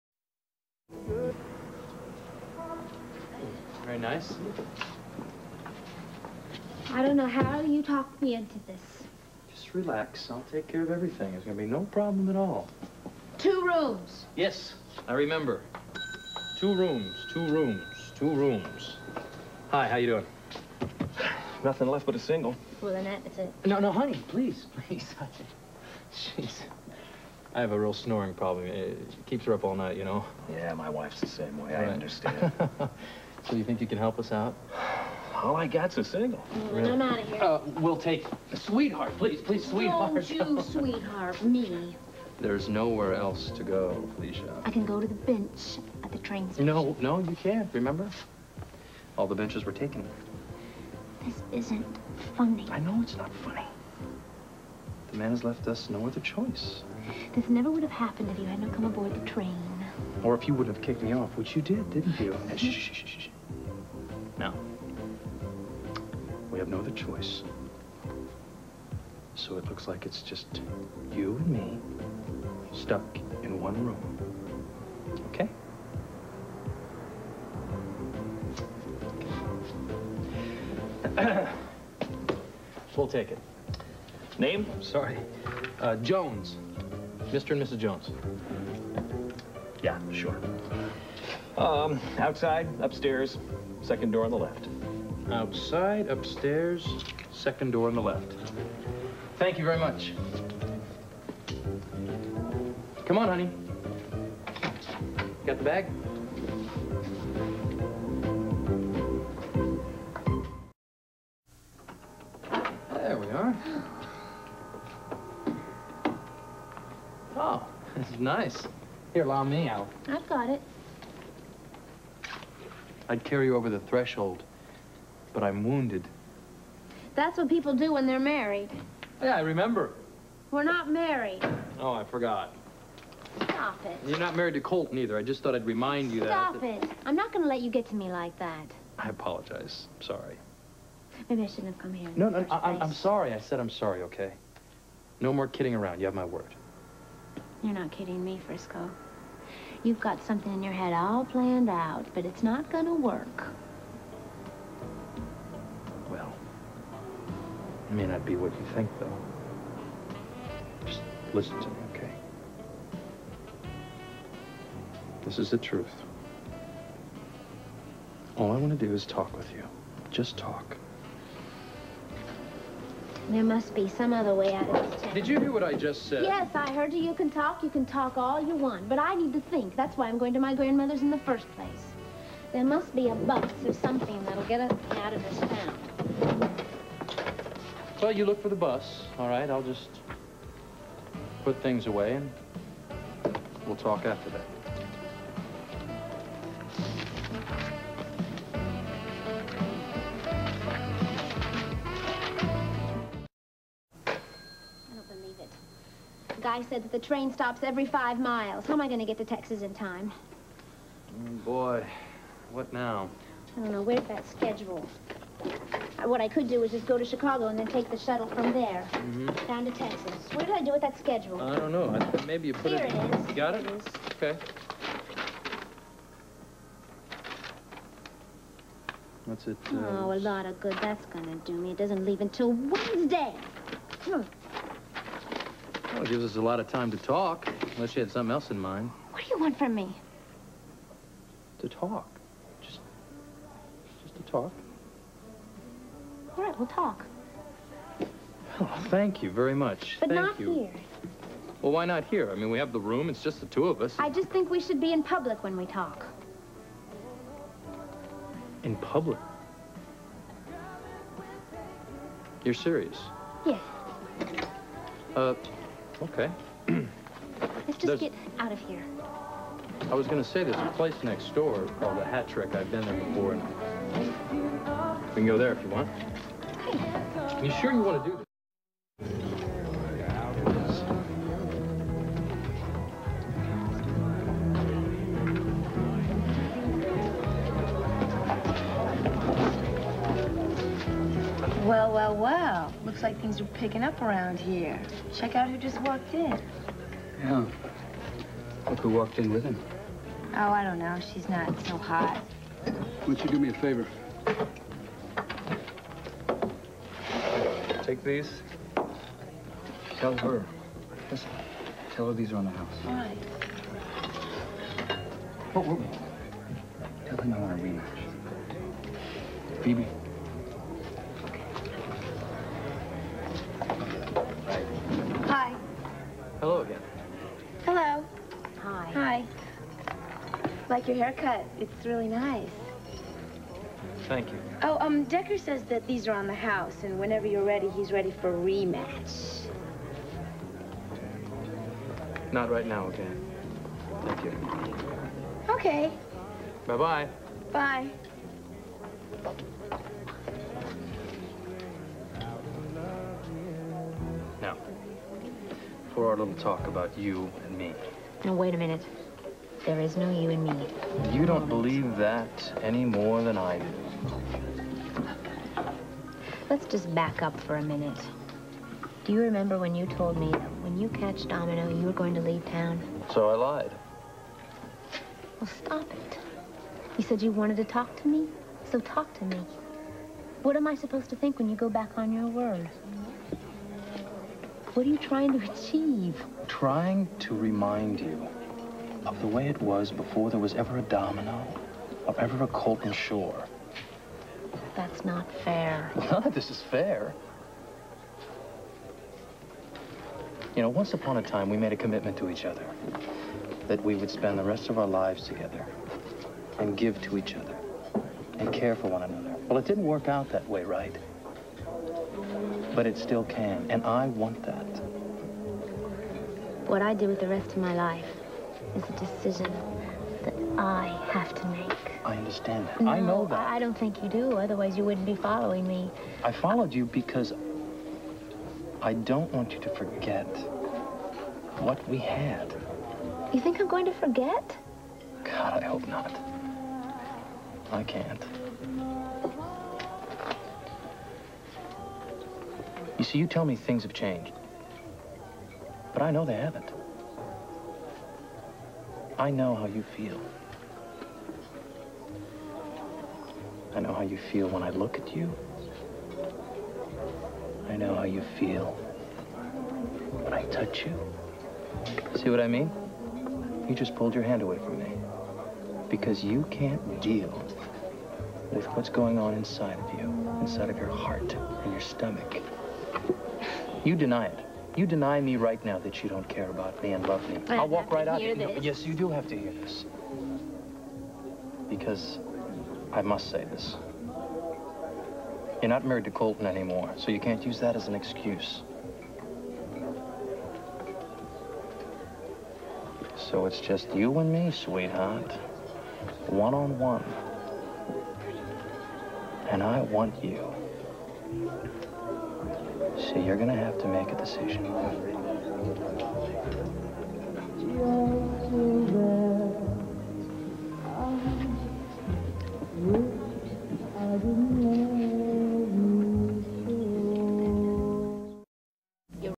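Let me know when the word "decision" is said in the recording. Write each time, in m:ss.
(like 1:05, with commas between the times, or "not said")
6:58, 8:24.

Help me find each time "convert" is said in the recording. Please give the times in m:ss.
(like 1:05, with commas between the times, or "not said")
not said.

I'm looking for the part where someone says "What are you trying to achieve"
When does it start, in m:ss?
6:24.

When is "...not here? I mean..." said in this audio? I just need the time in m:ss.
4:11.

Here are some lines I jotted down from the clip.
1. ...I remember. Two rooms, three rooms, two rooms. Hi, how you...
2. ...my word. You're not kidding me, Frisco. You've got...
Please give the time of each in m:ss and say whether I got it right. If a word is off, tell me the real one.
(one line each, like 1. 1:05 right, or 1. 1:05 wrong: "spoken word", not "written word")
1. 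0:15 wrong: "two", not "three"
2. 2:26 right.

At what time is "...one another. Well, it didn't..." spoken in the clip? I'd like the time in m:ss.
6:48.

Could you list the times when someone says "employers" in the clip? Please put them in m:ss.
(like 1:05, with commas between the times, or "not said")
not said.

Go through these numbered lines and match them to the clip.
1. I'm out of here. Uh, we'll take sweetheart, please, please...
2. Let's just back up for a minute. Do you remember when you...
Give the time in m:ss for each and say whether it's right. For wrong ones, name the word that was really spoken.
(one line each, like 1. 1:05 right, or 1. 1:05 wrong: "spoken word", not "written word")
1. 0:36 right
2. 6:06 right.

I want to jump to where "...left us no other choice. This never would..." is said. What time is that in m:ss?
0:55.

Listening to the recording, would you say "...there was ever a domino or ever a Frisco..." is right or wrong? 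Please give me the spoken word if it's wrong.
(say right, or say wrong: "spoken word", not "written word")
wrong: "Colton", not "Frisco".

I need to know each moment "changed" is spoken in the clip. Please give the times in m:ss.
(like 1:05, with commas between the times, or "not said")
7:23.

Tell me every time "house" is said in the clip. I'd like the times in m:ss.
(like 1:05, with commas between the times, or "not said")
5:12, 5:36.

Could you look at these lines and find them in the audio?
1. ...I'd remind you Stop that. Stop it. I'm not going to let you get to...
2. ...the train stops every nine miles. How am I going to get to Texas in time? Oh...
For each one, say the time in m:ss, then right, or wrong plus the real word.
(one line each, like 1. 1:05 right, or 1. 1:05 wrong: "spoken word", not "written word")
1. 2:15 right
2. 3:26 wrong: "five", not "nine".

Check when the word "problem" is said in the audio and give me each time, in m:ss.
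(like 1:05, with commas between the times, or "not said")
0:11, 0:28.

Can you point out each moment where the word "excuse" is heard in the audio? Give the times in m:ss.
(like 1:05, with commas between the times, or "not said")
8:07.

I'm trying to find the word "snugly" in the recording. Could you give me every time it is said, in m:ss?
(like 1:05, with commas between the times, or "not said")
not said.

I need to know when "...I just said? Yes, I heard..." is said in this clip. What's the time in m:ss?
2:55.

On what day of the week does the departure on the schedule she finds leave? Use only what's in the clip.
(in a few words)
Wednesday.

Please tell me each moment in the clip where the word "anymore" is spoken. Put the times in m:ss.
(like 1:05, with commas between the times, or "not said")
8:06.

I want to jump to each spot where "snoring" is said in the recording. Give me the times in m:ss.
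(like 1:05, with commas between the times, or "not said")
0:27.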